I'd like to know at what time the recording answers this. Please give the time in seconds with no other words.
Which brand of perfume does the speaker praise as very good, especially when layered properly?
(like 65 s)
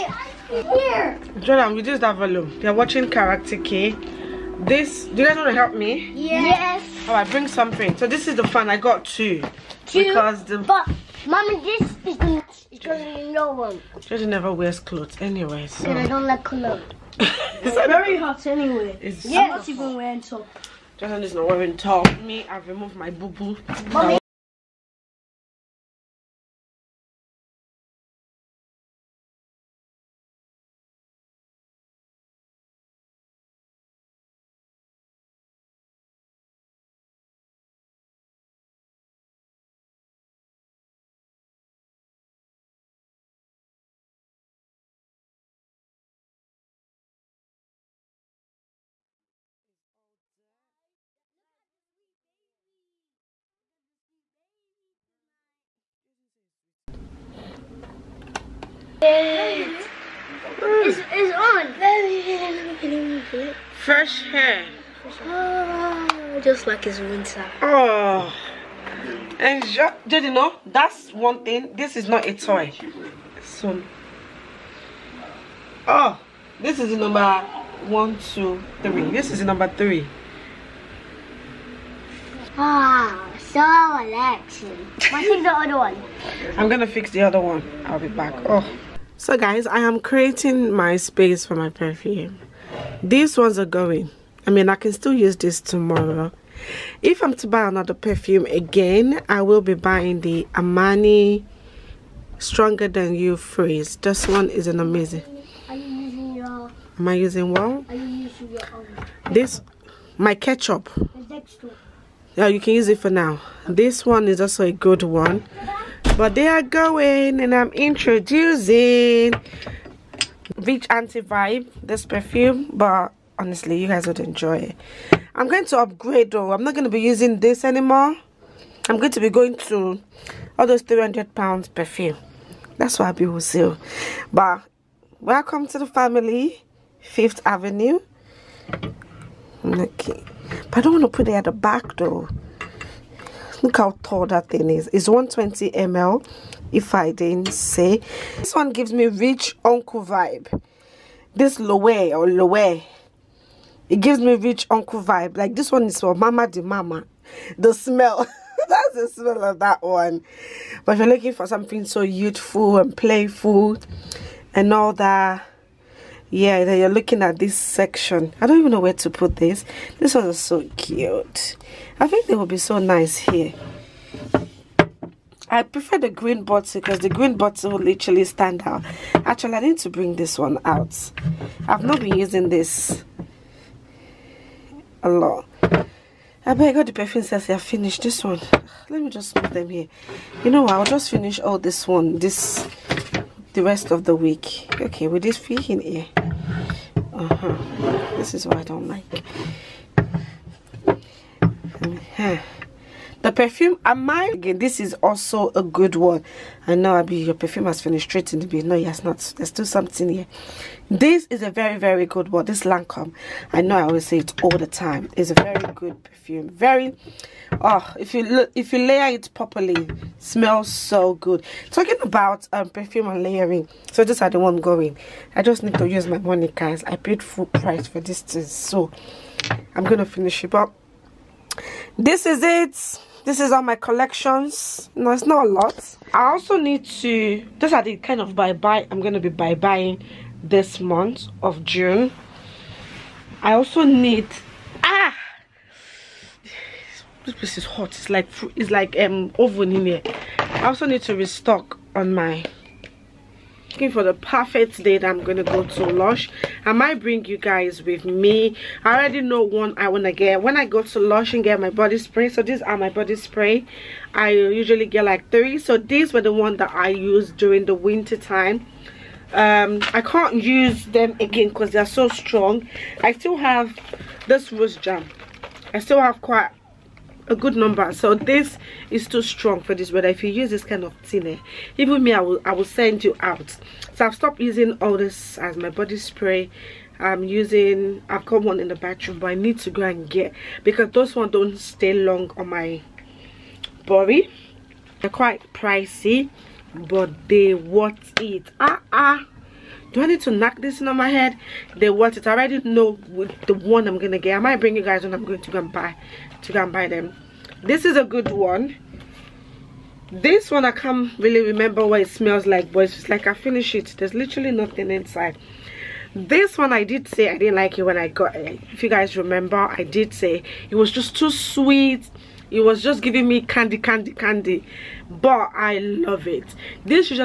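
212 s.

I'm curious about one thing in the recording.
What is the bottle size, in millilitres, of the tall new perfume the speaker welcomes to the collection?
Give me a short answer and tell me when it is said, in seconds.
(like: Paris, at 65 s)
120 ml, at 145 s.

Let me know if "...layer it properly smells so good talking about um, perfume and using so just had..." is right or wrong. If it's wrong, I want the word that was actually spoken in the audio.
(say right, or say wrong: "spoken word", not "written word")
wrong: "layering", not "using".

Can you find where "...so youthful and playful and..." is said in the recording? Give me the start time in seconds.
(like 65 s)
161 s.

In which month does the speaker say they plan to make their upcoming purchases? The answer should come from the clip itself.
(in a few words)
June.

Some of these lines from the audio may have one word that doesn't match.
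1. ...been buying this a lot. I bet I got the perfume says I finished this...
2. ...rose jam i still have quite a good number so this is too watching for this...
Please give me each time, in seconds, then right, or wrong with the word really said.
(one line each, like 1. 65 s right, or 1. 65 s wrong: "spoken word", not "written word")
1. 182 s wrong: "using", not "buying"
2. 274 s wrong: "strong", not "watching".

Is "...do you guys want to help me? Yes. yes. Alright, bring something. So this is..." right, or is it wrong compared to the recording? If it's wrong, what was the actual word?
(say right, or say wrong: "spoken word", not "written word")
right.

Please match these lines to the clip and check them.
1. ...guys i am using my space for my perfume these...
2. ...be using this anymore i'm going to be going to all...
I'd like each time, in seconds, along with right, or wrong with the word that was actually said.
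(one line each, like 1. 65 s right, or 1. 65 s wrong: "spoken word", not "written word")
1. 89 s wrong: "creating", not "using"
2. 126 s right.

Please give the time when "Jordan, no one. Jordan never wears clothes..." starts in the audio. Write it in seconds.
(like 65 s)
12 s.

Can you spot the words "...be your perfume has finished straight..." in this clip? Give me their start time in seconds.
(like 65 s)
207 s.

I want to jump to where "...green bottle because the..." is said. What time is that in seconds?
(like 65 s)
176 s.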